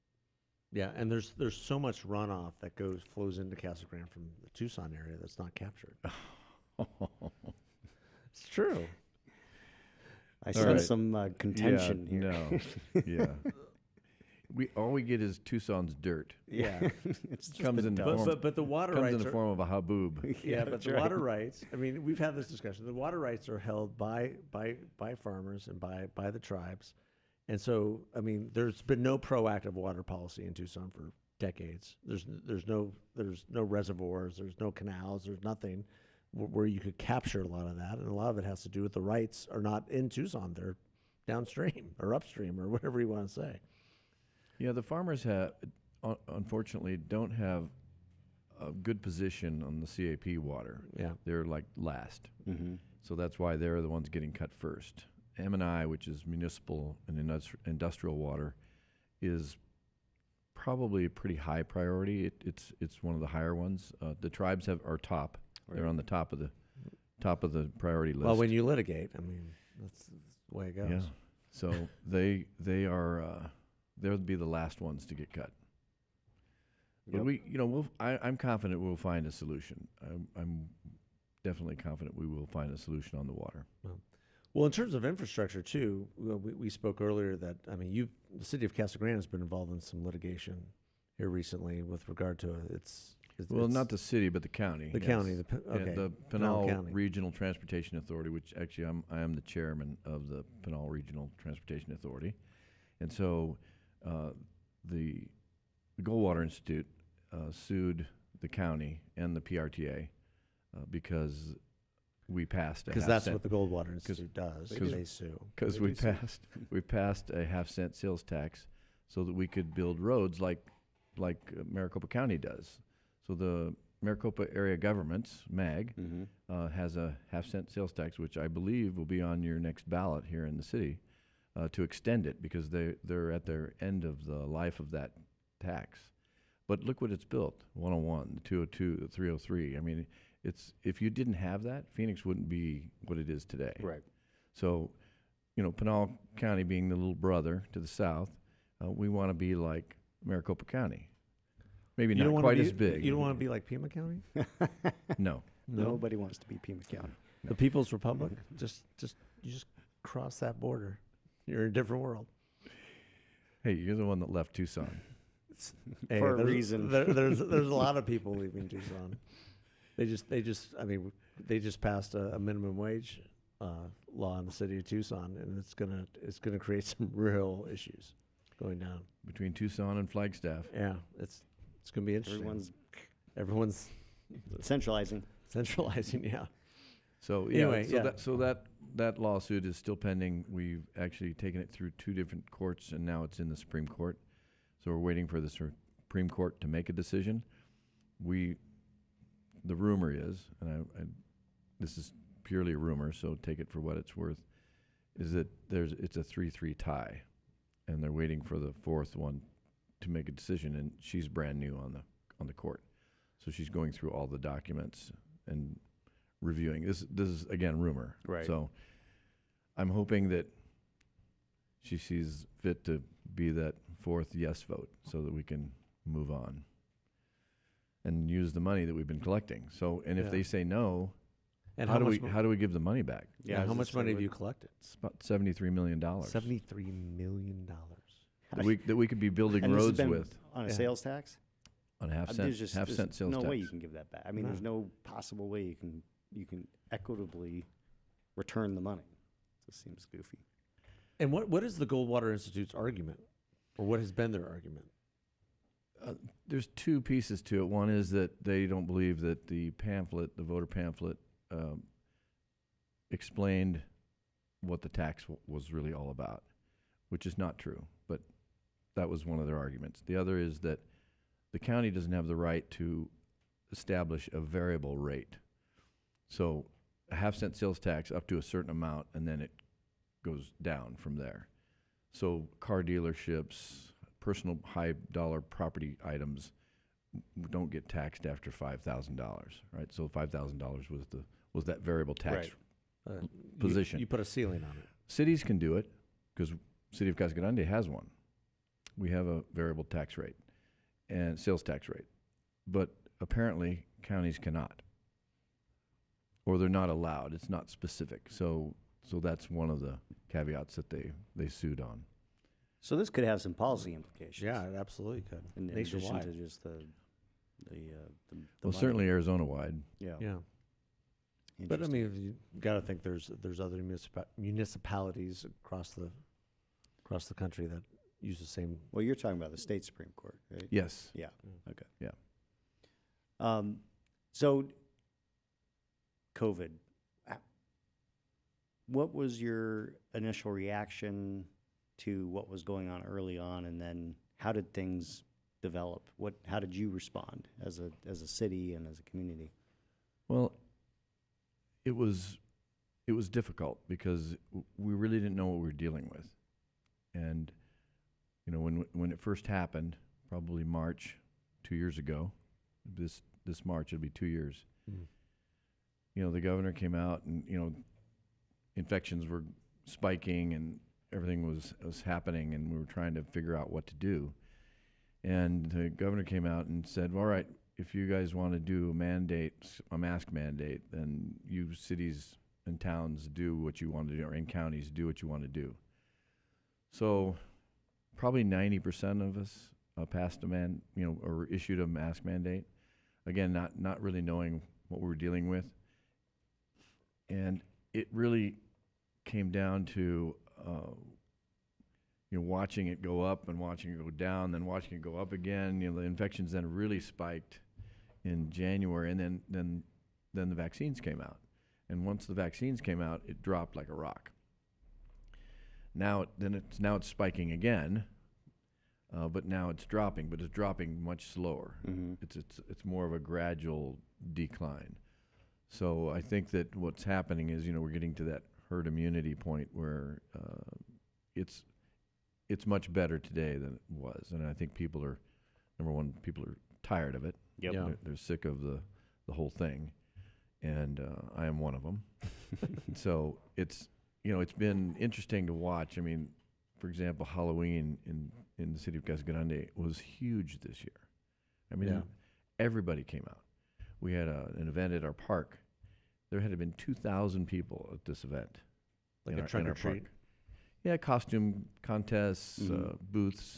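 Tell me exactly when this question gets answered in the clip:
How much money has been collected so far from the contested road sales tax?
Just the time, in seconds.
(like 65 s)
235 s.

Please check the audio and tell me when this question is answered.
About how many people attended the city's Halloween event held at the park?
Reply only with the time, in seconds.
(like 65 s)
456 s.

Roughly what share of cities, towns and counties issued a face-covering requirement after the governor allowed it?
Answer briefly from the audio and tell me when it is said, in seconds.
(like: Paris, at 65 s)
90%, at 388 s.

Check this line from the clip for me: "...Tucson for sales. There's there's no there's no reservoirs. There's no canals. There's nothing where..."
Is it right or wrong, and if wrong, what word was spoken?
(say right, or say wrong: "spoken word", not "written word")
wrong: "decades", not "sales".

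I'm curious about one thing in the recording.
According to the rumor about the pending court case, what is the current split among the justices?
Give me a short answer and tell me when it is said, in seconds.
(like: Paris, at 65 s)
3-3 tie, at 206 s.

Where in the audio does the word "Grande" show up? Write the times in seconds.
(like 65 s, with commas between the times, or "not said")
3 s, 88 s, 297 s, 449 s.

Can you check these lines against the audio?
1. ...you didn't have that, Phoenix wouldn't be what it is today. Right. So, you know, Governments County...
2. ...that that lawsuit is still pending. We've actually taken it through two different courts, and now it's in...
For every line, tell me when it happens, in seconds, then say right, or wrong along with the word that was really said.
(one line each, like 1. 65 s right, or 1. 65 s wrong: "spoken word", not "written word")
1. 140 s wrong: "Pinal", not "Governments"
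2. 188 s right.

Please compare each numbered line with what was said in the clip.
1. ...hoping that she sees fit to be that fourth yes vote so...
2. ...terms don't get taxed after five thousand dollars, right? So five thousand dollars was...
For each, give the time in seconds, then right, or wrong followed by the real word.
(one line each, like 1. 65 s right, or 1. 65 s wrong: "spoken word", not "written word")
1. 219 s right
2. 286 s wrong: "items", not "terms".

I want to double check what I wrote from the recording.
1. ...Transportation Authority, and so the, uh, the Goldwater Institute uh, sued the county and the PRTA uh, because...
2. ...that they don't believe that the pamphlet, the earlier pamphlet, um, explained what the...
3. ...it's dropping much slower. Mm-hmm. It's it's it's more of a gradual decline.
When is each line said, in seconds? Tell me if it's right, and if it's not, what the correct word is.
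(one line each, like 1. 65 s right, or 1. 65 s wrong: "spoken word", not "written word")
1. 101 s right
2. 258 s wrong: "voter", not "earlier"
3. 420 s right.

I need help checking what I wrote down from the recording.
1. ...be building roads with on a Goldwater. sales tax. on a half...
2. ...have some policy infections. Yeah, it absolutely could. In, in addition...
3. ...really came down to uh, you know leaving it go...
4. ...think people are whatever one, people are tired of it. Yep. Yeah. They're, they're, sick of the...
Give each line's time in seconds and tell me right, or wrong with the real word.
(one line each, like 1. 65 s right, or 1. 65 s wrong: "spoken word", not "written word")
1. 239 s wrong: "Yeah", not "Goldwater"
2. 313 s wrong: "implications", not "infections"
3. 398 s wrong: "watching", not "leaving"
4. 434 s wrong: "number", not "whatever".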